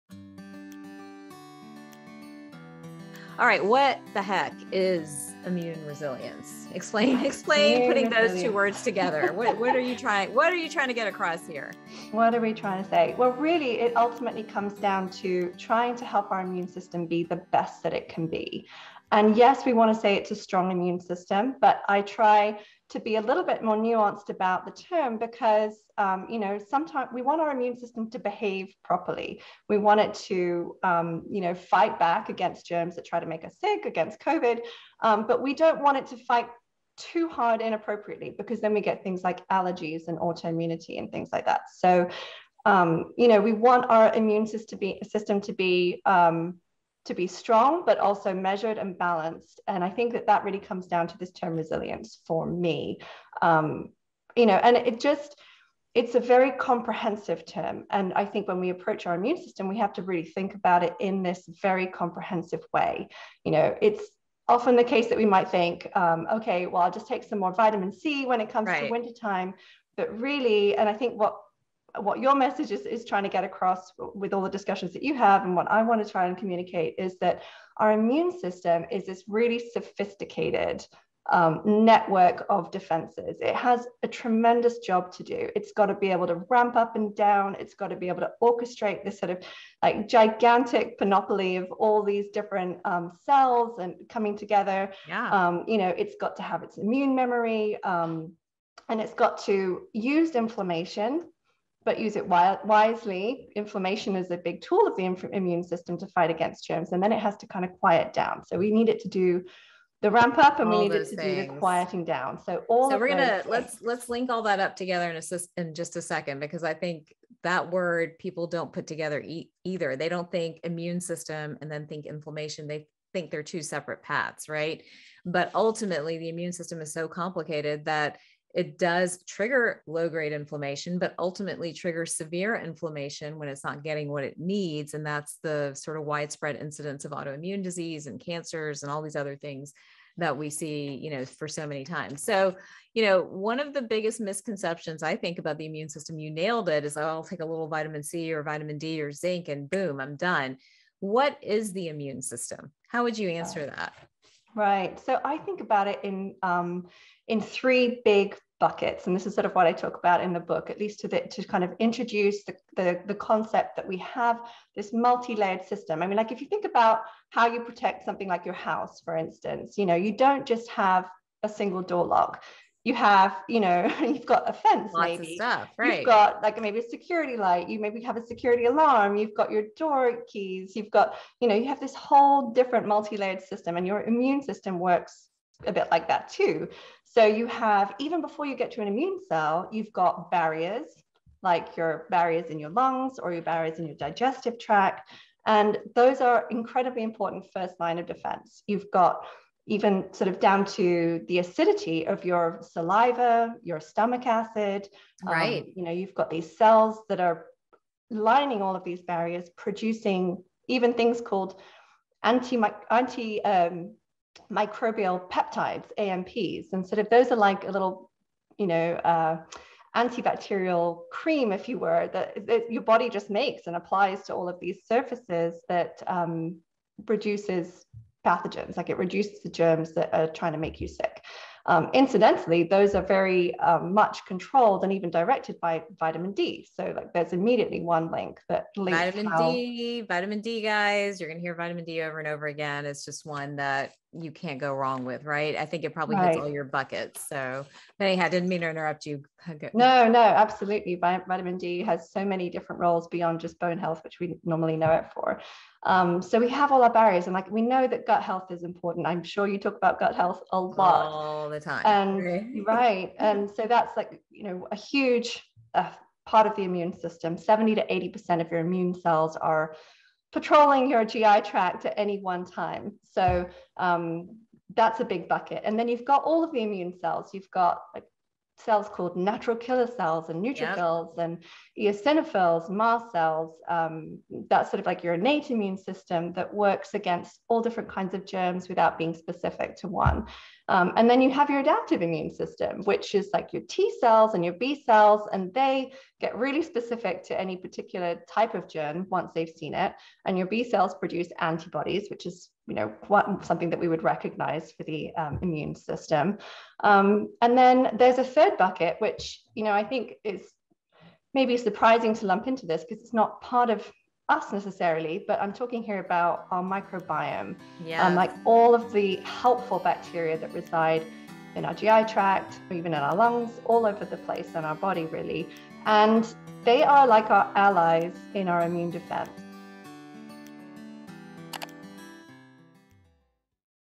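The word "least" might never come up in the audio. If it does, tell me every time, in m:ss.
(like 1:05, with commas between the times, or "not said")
2:40.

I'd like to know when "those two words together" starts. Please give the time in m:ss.
0:08.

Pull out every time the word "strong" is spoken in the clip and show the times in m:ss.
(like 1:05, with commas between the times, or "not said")
0:20, 0:47.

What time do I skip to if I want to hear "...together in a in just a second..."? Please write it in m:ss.
1:54.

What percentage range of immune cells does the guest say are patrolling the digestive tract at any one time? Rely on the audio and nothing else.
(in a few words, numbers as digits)
70 to 80 percent.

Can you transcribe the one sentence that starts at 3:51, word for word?
Um, incidentally, those are very um, much controlled and even directed by vitamin D.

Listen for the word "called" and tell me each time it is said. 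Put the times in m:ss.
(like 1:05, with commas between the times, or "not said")
3:31, 4:38.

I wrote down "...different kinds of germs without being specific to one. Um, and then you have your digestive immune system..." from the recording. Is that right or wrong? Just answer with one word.
wrong.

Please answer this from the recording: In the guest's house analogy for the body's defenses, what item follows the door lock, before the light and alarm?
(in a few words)
a fence.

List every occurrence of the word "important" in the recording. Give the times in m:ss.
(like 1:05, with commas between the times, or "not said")
3:17, 4:18.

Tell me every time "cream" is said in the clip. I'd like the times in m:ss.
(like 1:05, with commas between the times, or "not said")
3:41.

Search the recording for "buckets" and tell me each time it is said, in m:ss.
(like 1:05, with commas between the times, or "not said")
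2:38, 4:06, 4:35, 5:08.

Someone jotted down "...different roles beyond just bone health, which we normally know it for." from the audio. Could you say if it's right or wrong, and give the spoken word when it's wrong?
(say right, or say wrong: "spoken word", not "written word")
right.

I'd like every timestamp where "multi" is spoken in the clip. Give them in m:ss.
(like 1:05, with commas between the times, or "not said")
2:44, 3:02.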